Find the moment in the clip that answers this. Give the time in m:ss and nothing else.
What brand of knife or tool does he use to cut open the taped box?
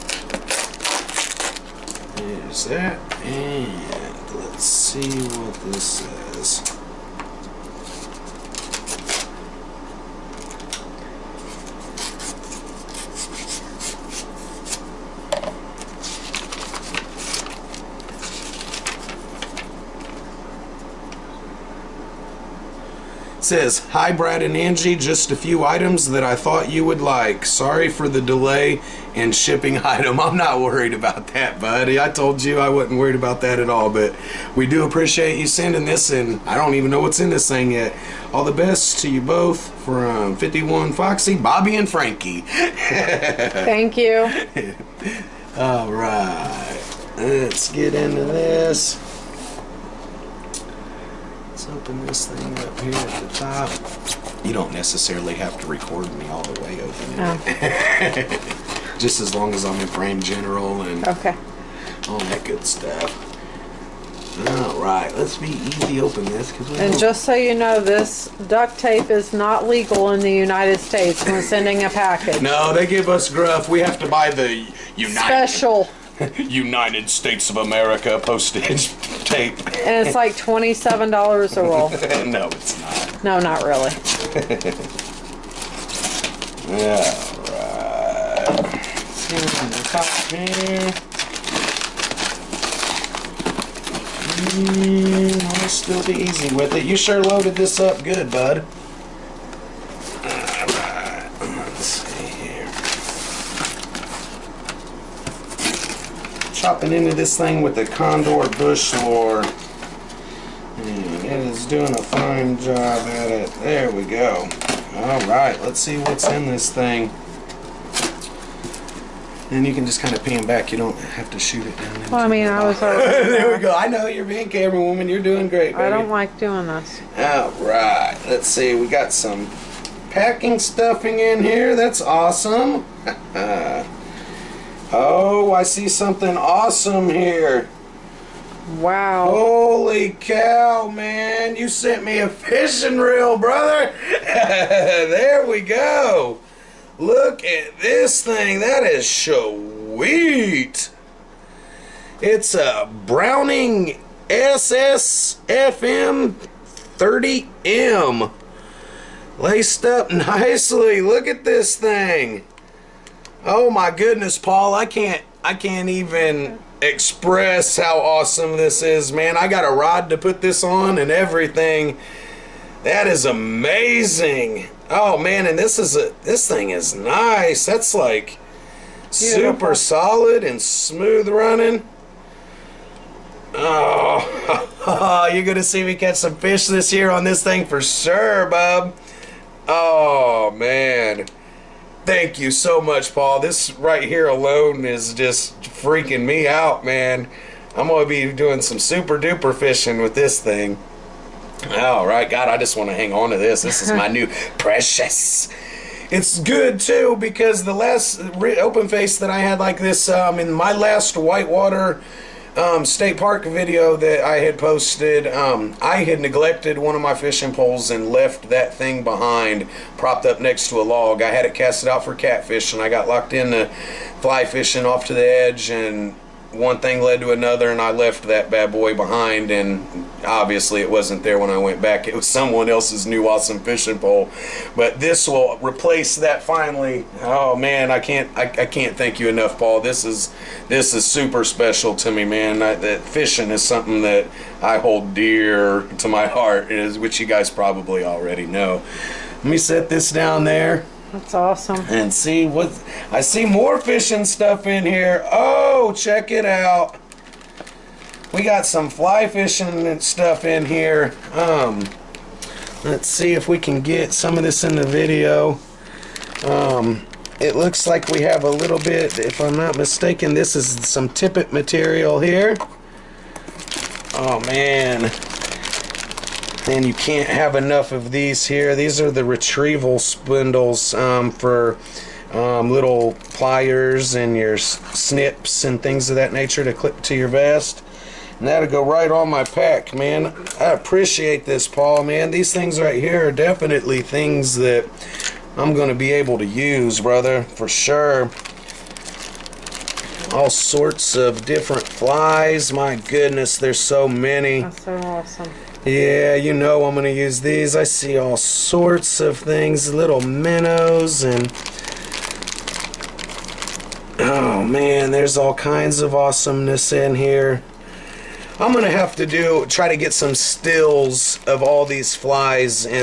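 1:47.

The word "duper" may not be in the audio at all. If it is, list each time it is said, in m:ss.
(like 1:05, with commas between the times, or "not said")
3:19.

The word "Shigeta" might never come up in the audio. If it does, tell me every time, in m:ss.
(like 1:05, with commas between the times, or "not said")
not said.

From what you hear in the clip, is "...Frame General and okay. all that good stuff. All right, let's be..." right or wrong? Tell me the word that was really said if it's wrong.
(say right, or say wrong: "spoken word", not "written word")
right.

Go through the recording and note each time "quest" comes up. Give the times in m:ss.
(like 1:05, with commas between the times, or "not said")
not said.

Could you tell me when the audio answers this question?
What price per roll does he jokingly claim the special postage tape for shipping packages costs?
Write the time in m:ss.
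1:20.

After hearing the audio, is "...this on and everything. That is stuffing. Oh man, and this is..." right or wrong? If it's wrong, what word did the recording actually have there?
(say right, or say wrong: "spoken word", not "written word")
wrong: "amazing", not "stuffing".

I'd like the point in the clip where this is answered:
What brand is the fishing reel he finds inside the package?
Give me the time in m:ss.
2:33.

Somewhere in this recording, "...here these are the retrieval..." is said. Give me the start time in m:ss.
4:38.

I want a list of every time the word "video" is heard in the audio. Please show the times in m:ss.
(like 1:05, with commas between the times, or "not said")
3:33, 4:24.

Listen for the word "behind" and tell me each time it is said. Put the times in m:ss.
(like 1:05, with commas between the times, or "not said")
3:39, 3:48.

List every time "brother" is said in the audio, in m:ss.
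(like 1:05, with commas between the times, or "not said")
2:23, 4:57.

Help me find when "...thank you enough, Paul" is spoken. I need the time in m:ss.
3:58.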